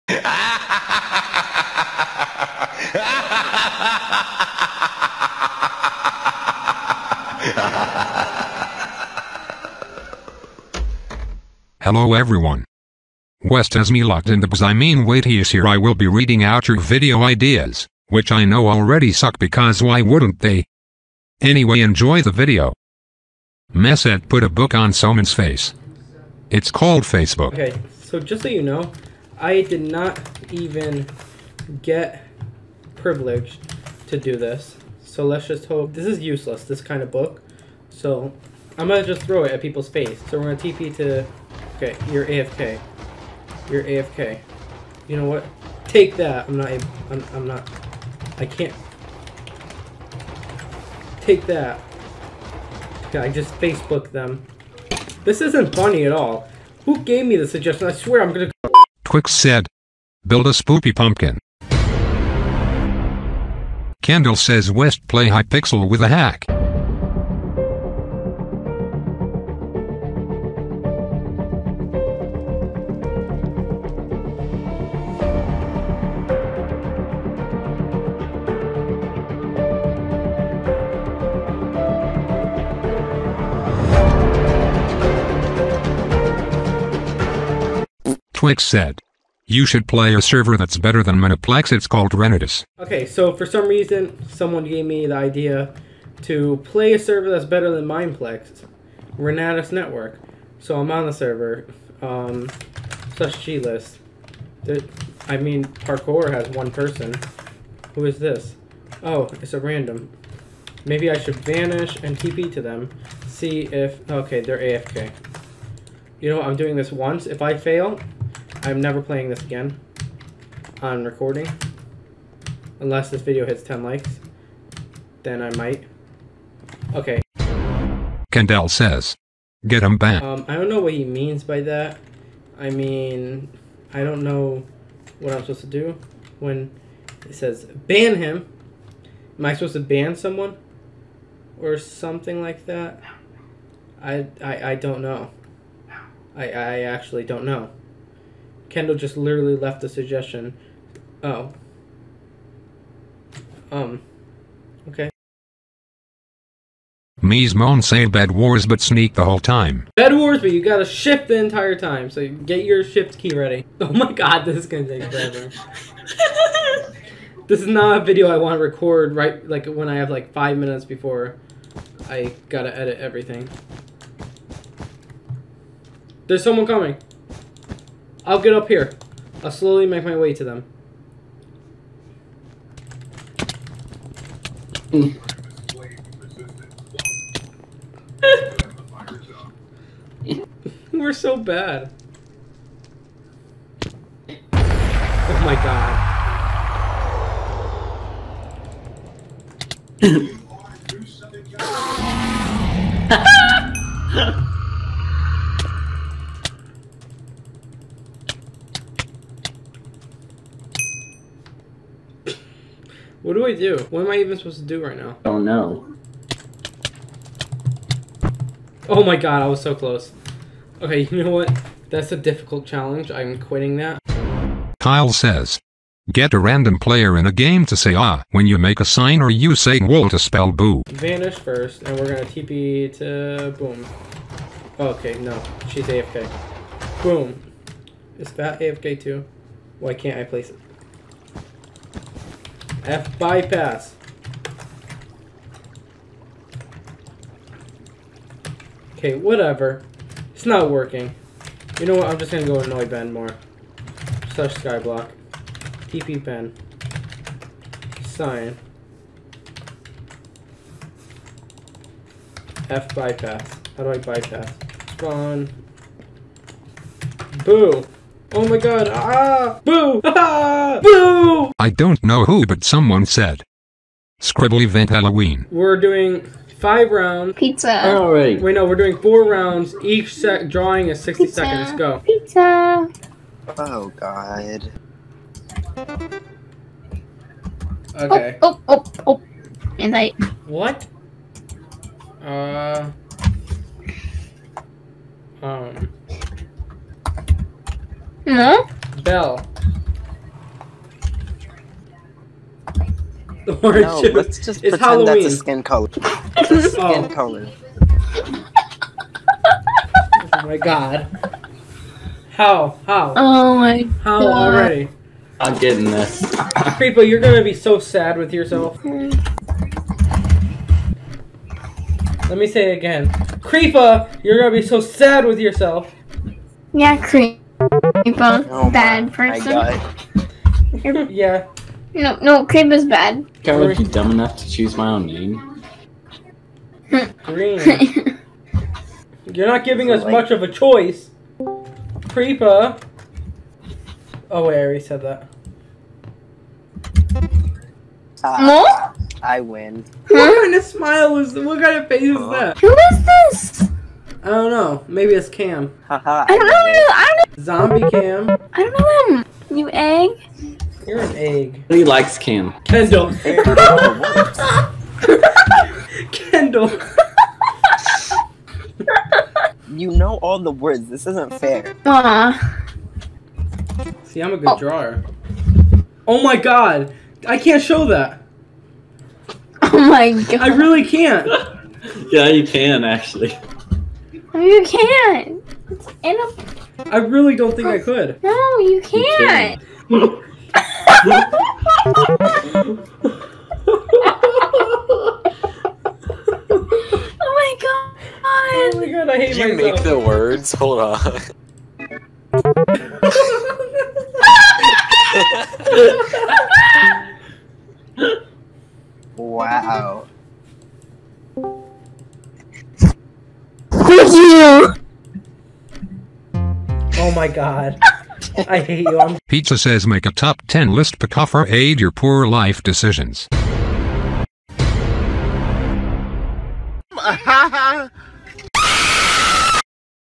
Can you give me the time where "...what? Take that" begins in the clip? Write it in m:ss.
0:45.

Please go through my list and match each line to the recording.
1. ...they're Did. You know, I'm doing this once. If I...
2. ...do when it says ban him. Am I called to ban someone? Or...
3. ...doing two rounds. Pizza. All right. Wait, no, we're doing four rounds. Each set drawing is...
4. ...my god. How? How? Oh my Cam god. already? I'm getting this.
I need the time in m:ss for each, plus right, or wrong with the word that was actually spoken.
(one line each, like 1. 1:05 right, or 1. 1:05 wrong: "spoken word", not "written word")
1. 1:54 wrong: "AFK", not "Did"
2. 2:15 wrong: "supposed", not "called"
3. 4:35 wrong: "five", not "two"
4. 5:10 wrong: "How", not "Cam".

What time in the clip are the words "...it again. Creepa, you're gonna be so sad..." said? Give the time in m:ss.
5:22.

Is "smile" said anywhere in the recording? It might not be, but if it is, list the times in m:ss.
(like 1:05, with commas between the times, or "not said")
5:50.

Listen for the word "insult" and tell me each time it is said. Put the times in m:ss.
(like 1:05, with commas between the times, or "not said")
not said.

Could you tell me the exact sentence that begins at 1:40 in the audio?
So I'm on the server, um, such G list.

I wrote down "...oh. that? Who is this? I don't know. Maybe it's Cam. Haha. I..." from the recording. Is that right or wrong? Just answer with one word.
right.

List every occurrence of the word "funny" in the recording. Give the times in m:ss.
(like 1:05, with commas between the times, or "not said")
0:55.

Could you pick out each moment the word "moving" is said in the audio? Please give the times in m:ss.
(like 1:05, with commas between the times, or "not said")
not said.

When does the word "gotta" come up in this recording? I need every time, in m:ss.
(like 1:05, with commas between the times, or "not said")
2:40, 2:52.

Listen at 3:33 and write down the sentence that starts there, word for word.
What am I even supposed to do right now?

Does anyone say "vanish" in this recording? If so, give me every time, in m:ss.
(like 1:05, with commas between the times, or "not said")
1:51, 3:50.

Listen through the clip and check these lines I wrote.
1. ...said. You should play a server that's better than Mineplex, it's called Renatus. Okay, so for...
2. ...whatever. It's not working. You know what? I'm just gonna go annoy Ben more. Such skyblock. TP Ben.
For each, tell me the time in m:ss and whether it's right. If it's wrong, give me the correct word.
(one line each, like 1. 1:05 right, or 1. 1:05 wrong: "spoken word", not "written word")
1. 1:28 right
2. 4:09 right.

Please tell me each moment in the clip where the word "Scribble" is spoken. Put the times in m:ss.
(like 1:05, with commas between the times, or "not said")
4:34.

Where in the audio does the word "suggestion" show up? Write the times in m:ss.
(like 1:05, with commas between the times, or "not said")
0:57, 2:29.